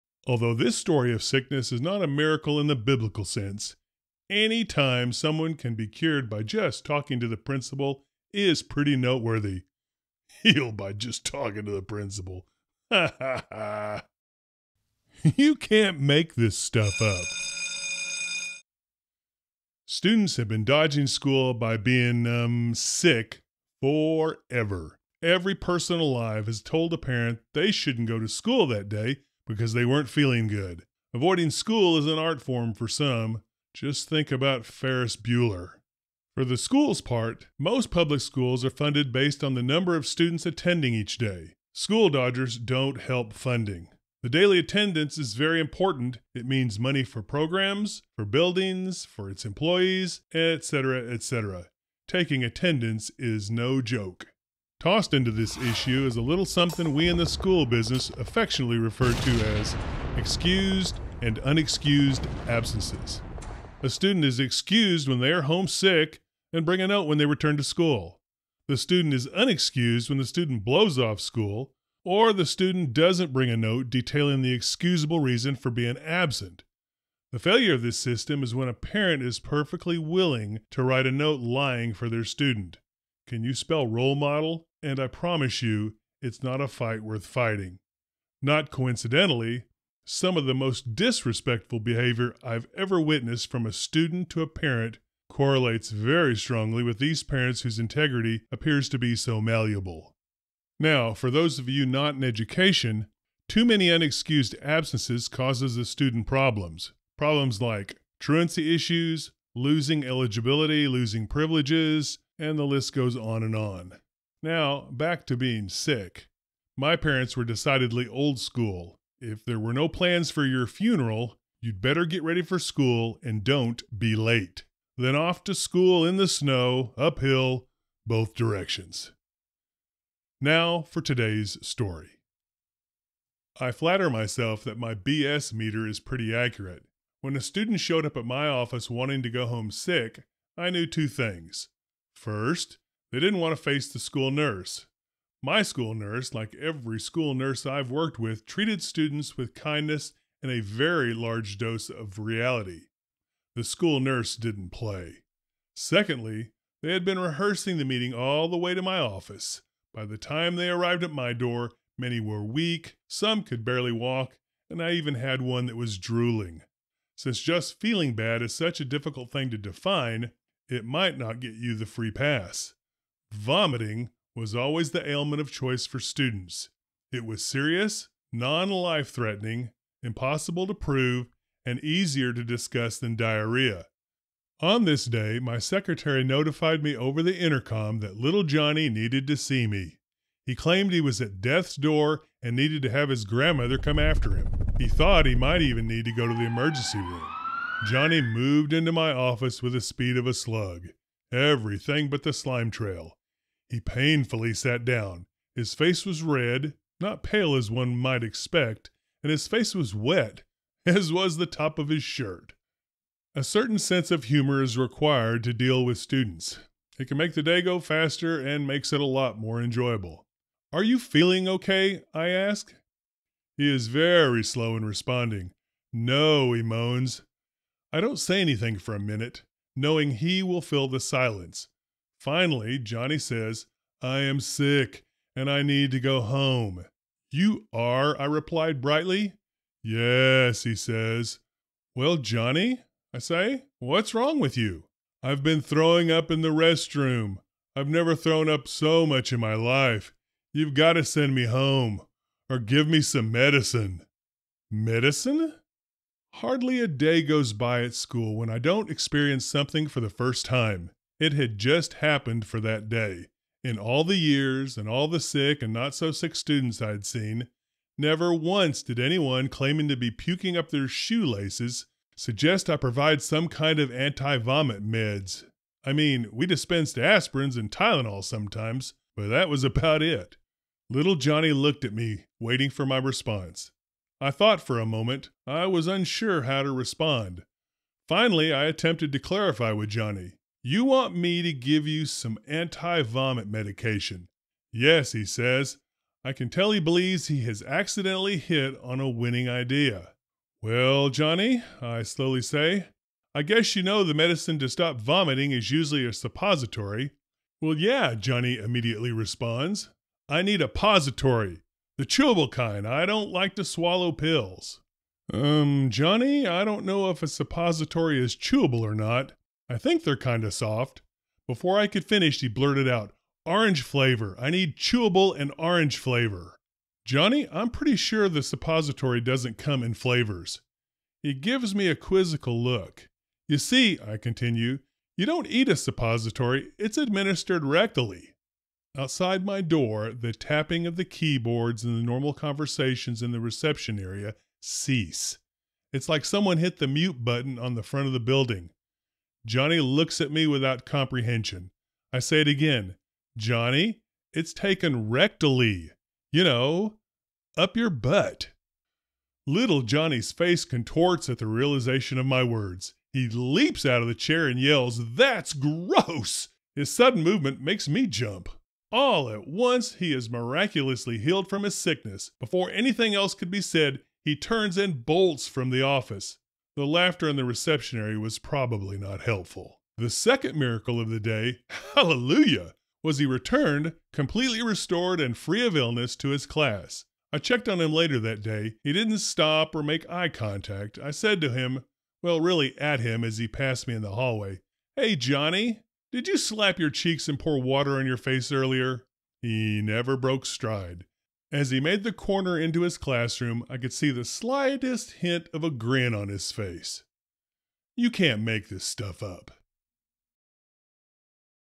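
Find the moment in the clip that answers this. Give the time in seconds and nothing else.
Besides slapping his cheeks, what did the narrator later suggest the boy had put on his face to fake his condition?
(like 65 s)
397 s.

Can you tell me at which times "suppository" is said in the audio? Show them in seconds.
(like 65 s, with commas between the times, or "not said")
306 s, 317 s, 328 s, 335 s.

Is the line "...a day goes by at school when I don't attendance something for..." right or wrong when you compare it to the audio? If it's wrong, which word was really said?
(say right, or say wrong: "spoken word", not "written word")
wrong: "experience", not "attendance".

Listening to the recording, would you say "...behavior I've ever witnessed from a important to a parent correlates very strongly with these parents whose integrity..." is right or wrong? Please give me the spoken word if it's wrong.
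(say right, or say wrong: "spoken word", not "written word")
wrong: "student", not "important".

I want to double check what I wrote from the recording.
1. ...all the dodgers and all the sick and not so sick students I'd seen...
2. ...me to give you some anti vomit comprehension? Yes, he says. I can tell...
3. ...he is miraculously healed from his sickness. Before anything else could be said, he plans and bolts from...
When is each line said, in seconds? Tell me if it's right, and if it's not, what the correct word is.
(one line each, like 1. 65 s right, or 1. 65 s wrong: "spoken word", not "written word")
1. 263 s wrong: "years", not "dodgers"
2. 291 s wrong: "medication", not "comprehension"
3. 369 s wrong: "turns", not "plans".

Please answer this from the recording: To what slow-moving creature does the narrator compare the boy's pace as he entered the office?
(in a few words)
a slug.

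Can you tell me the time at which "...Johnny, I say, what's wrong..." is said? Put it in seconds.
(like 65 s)
242 s.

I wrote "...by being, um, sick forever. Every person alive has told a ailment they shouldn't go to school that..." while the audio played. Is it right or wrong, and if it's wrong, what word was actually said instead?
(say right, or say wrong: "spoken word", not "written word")
wrong: "parent", not "ailment".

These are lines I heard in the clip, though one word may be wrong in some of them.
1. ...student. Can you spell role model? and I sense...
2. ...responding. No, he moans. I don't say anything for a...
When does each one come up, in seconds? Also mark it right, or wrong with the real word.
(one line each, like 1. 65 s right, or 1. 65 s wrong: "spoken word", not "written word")
1. 82 s wrong: "promise", not "sense"
2. 224 s right.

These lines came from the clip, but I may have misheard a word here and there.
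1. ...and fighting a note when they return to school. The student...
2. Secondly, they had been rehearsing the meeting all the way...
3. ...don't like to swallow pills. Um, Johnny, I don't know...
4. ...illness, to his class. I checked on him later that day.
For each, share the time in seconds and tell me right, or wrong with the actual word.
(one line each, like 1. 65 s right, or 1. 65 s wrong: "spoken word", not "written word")
1. 66 s wrong: "bring", not "fighting"
2. 155 s right
3. 313 s right
4. 385 s right.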